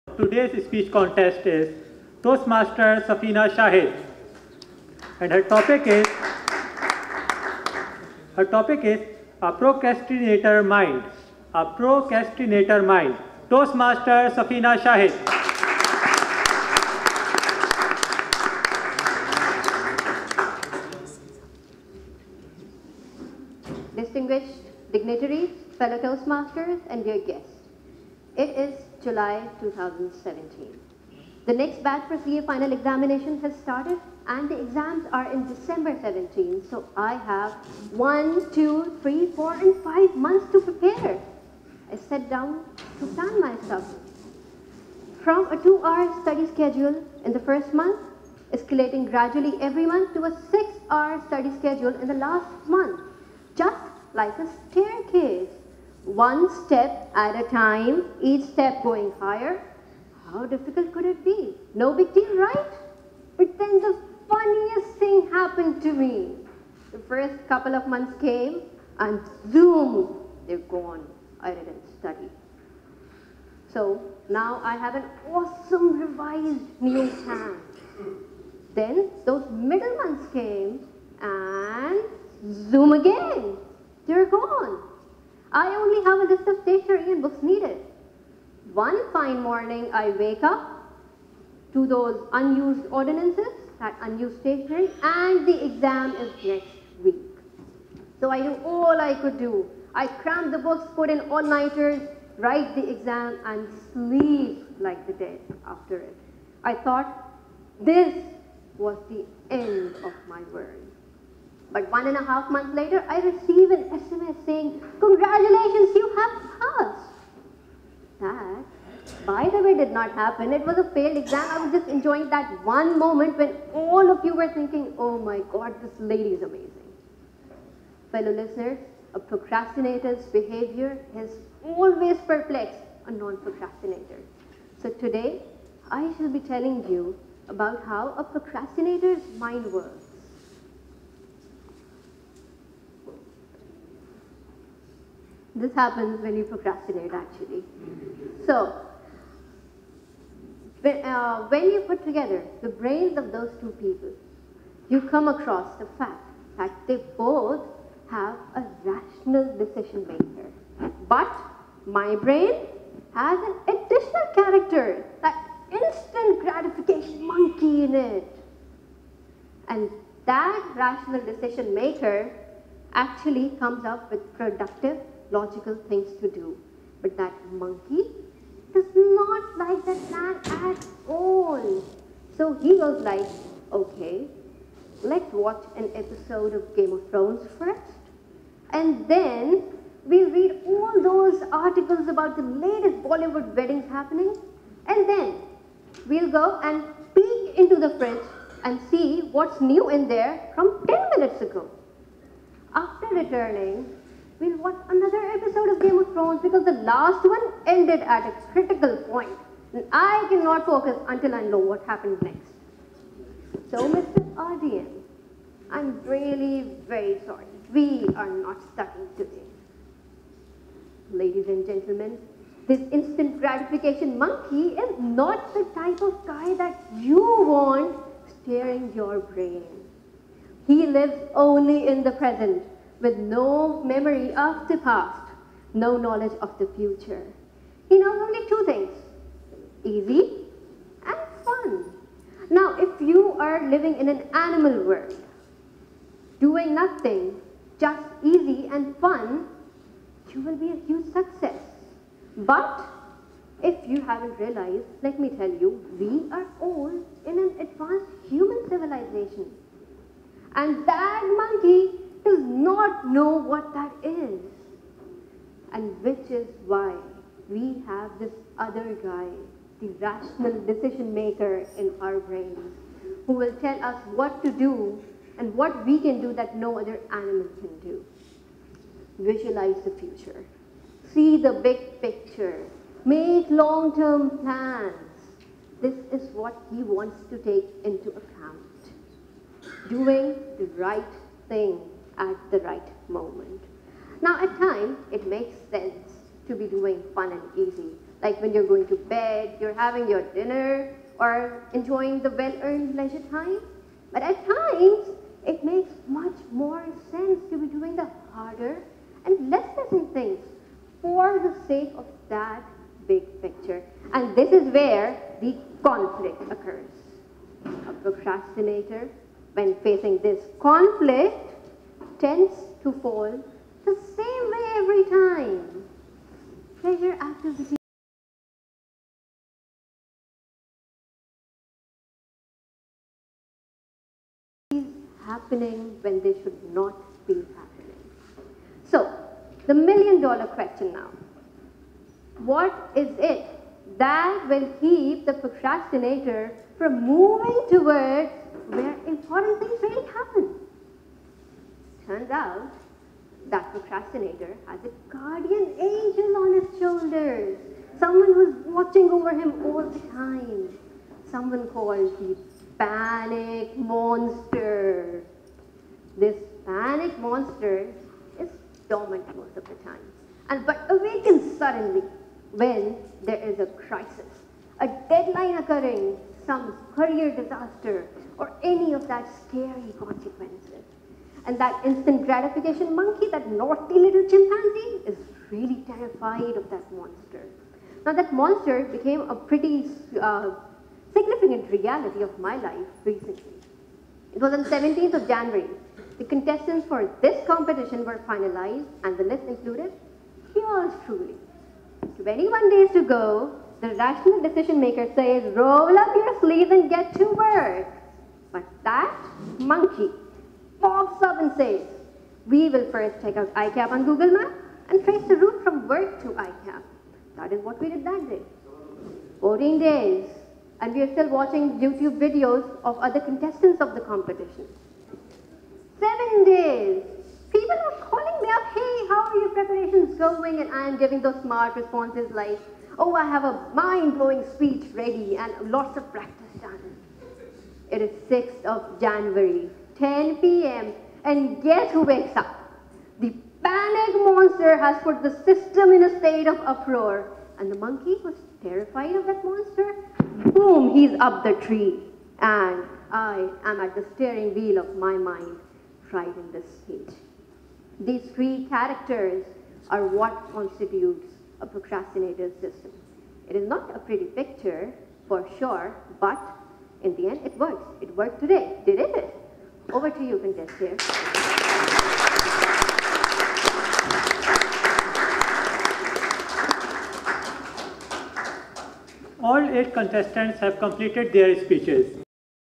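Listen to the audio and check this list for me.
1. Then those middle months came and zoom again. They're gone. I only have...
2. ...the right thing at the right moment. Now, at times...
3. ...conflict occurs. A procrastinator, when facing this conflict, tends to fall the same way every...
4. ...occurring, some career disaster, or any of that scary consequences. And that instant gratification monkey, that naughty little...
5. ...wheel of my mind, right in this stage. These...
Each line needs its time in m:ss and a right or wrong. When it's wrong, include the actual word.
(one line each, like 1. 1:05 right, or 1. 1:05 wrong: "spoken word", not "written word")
1. 1:18 right
2. 4:50 right
3. 5:15 right
4. 6:15 right
5. 7:34 right.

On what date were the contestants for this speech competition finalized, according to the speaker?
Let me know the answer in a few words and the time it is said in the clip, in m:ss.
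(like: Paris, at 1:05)
17 January, at 6:34.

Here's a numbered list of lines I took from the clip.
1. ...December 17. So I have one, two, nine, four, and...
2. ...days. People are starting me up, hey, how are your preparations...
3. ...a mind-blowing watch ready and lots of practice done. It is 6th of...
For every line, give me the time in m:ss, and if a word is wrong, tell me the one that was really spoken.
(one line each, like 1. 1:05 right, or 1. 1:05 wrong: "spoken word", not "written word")
1. 0:35 wrong: "three", not "nine"
2. 7:06 wrong: "calling", not "starting"
3. 7:13 wrong: "speech", not "watch".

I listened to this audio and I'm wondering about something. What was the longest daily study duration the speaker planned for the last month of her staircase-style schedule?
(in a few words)
6 hours.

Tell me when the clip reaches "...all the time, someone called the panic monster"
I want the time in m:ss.
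5:59.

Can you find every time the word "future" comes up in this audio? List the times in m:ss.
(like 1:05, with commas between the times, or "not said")
3:56, 4:39.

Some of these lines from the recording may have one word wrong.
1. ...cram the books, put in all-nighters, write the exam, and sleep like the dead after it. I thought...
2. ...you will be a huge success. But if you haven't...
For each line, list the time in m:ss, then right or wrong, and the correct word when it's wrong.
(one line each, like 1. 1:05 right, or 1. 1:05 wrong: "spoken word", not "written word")
1. 1:40 right
2. 4:10 right.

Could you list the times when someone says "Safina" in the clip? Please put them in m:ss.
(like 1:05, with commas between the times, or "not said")
0:03, 0:14.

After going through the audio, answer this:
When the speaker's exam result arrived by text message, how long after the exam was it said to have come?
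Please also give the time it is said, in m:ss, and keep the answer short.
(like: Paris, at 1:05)
1.5 months, at 1:51.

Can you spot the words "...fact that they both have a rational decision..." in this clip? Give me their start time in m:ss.
2:35.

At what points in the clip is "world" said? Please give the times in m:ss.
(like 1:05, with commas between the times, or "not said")
1:50, 4:04.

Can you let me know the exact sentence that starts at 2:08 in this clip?
Fellow listeners, a procrastinator's behavior is always perplexed a non-procrastinator.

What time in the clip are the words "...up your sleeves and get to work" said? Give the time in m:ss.
6:45.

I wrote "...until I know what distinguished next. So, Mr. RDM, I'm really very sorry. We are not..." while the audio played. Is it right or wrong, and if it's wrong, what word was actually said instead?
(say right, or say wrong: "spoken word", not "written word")
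wrong: "happened", not "distinguished".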